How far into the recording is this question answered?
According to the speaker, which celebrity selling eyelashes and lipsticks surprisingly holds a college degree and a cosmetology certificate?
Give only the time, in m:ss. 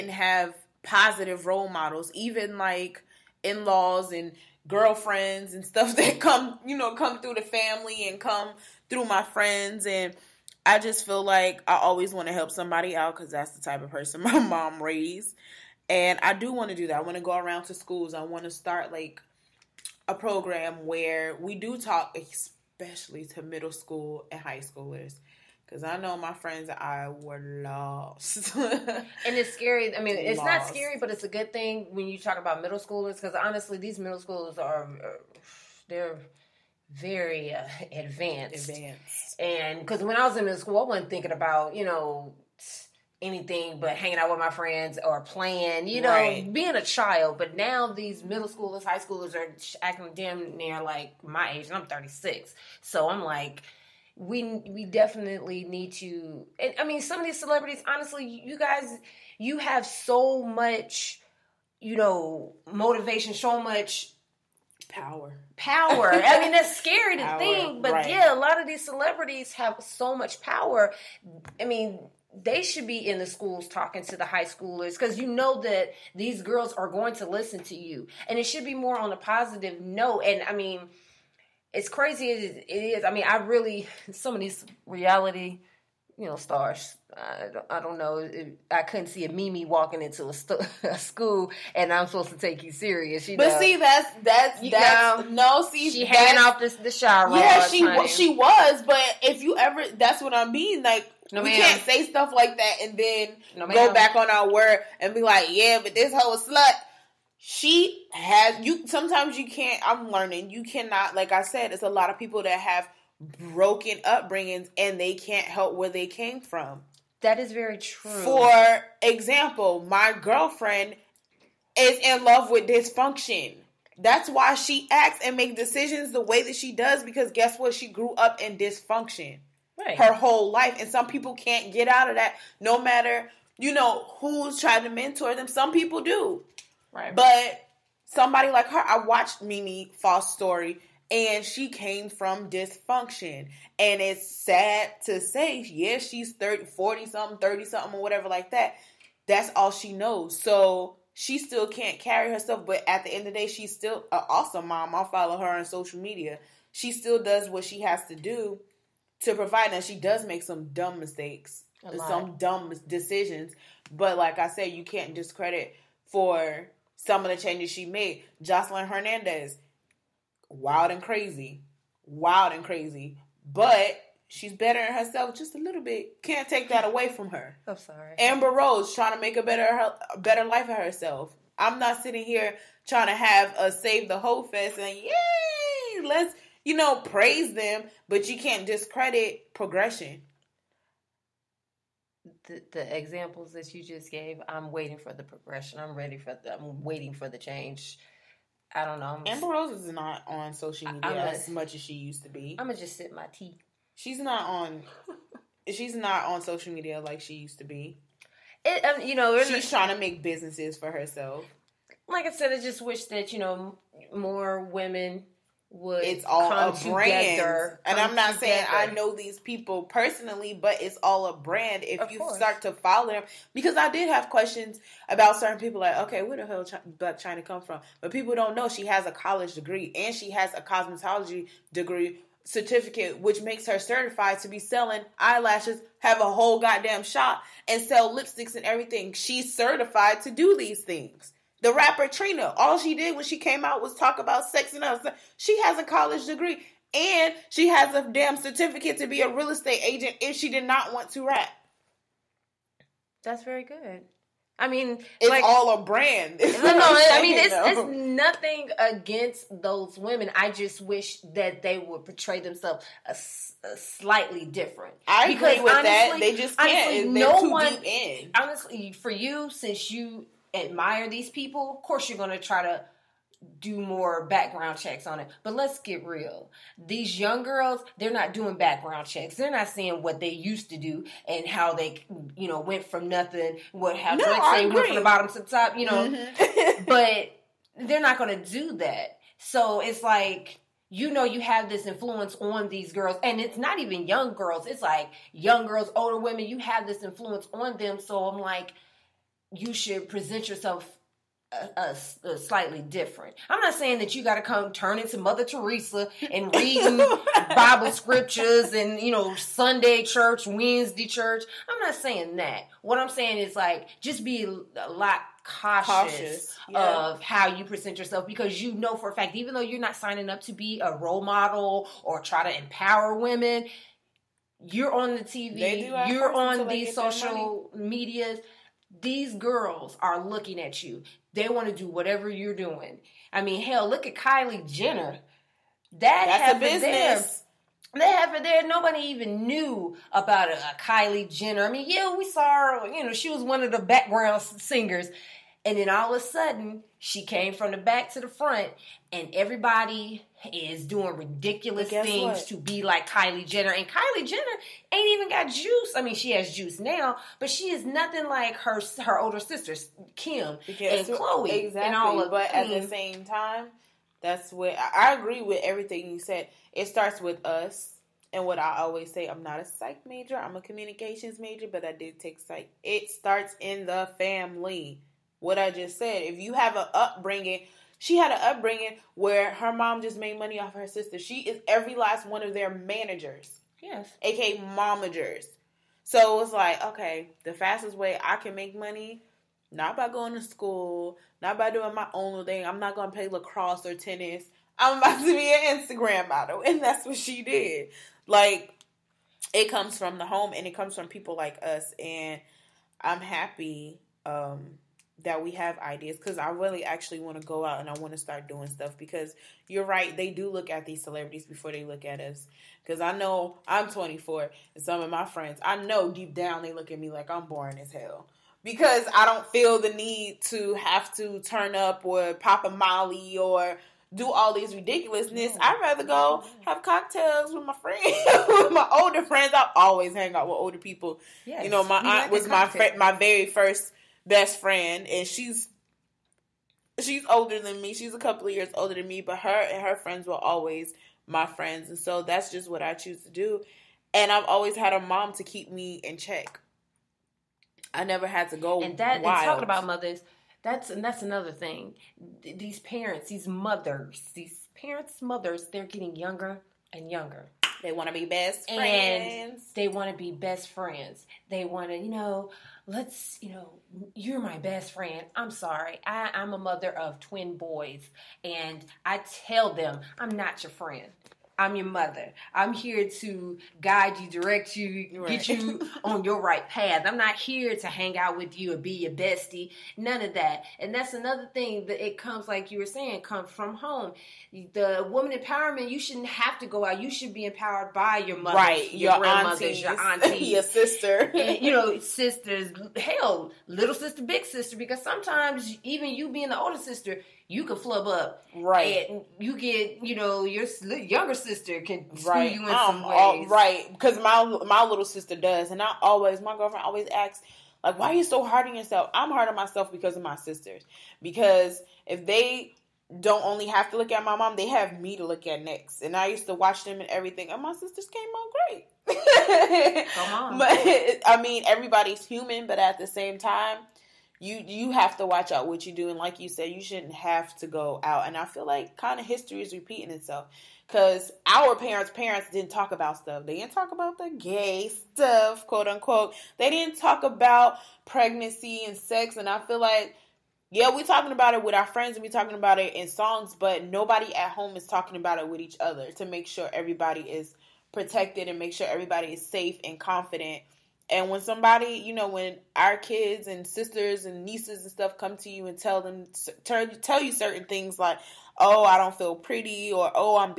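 3:46.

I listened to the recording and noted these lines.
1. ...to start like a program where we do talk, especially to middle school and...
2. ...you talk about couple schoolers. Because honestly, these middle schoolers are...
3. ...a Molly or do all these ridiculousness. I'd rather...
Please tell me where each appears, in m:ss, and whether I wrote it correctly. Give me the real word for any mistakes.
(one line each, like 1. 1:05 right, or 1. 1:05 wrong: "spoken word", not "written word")
1. 0:18 right
2. 0:32 wrong: "middle", not "couple"
3. 7:02 right.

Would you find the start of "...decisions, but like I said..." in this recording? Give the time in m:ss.
2:42.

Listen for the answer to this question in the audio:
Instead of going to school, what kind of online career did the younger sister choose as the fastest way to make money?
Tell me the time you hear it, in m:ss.
6:35.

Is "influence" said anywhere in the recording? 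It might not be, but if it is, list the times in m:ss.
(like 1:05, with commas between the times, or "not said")
4:51, 4:57.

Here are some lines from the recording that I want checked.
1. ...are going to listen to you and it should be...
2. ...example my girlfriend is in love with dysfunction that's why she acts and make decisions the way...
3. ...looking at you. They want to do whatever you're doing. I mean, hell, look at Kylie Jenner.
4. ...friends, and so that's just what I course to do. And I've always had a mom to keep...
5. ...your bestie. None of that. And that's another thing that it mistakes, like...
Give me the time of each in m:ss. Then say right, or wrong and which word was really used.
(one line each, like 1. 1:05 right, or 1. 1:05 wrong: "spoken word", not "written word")
1. 1:16 right
2. 1:59 right
3. 5:30 right
4. 7:21 wrong: "choose", not "course"
5. 7:58 wrong: "comes", not "mistakes".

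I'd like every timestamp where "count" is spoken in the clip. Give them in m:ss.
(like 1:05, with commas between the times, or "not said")
not said.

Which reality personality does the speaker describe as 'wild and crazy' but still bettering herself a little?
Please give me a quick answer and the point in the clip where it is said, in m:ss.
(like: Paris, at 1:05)
Joseline Hernandez, at 2:48.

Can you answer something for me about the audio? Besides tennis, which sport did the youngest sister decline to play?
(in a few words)
Lacrosse.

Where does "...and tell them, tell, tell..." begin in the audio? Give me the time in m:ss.
9:15.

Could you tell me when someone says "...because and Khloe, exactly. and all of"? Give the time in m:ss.
6:00.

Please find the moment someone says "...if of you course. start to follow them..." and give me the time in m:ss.
3:41.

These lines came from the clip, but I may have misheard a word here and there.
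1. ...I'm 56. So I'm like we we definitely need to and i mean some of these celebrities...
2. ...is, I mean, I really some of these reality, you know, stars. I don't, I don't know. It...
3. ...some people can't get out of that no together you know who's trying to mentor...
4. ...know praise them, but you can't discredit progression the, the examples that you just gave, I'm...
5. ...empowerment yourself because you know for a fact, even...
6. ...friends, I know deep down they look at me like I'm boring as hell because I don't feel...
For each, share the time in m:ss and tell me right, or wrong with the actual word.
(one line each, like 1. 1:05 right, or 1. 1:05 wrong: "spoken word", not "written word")
1. 0:51 wrong: "36", not "56"
2. 1:22 right
3. 2:10 wrong: "matter", not "together"
4. 3:06 right
5. 5:17 wrong: "present", not "empowerment"
6. 6:55 right.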